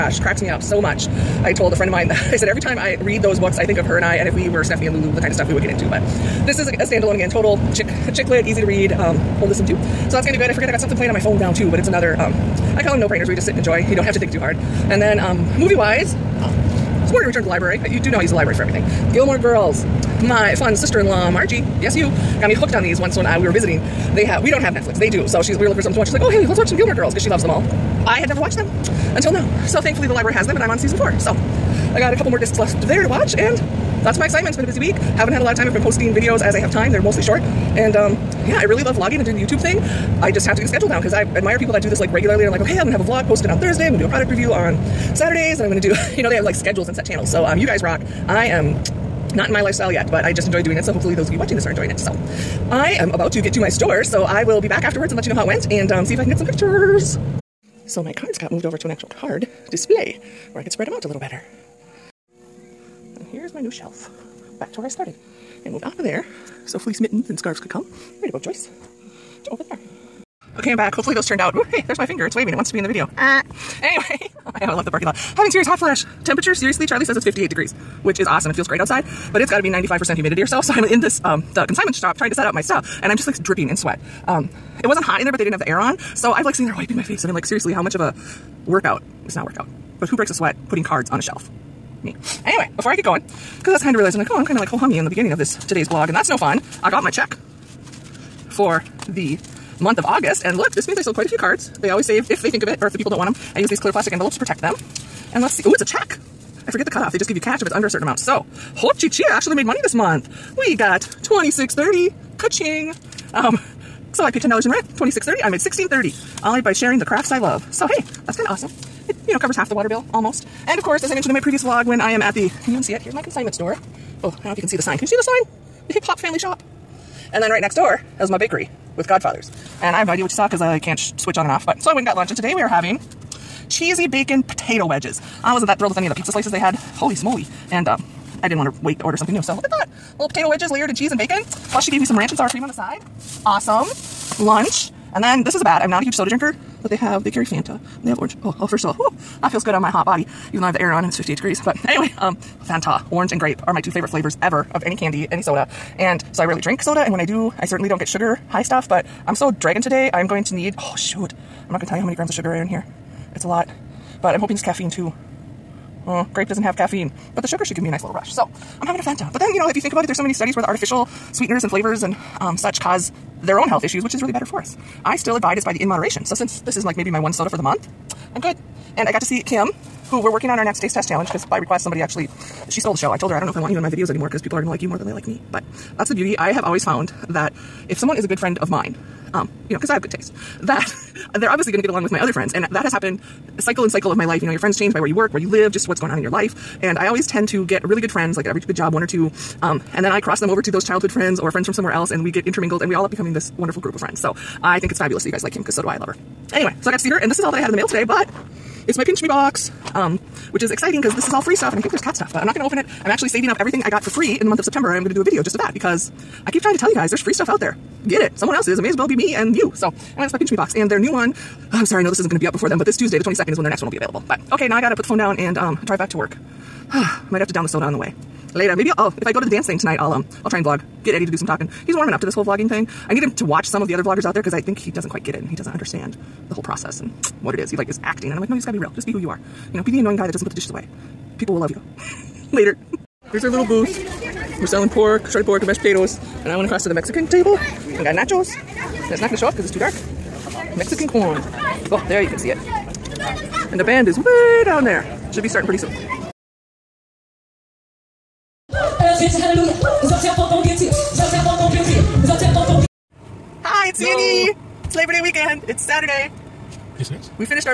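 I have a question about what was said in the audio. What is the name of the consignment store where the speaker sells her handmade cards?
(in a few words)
The Hip Hop Family Shop.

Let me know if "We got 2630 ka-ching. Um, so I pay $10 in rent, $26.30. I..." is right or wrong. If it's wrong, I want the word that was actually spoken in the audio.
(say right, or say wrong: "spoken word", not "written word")
right.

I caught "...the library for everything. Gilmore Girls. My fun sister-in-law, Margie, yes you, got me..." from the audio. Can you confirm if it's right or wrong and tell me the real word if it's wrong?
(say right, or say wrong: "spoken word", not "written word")
right.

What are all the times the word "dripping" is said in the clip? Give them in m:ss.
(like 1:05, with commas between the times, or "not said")
1:23.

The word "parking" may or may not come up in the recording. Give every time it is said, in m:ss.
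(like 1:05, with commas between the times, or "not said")
1:14.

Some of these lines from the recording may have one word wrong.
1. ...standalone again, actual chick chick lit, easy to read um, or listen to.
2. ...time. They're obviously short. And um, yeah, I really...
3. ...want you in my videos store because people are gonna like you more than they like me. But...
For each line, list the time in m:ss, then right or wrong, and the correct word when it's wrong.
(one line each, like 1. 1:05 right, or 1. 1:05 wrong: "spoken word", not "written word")
1. 0:06 wrong: "total", not "actual"
2. 0:36 wrong: "mostly", not "obviously"
3. 3:03 wrong: "anymore", not "store".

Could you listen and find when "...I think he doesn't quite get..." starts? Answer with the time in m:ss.
3:54.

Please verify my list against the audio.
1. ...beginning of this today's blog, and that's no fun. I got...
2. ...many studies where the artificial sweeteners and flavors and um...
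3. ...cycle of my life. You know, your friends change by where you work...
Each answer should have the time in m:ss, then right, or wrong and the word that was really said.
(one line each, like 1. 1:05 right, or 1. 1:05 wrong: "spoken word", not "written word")
1. 1:35 right
2. 2:50 right
3. 3:13 right.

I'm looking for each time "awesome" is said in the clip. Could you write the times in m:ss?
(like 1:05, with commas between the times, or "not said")
1:18, 1:58, 2:23.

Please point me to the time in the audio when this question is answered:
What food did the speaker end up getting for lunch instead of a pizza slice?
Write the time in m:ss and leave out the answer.
2:13.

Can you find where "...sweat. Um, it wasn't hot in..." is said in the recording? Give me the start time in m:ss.
1:23.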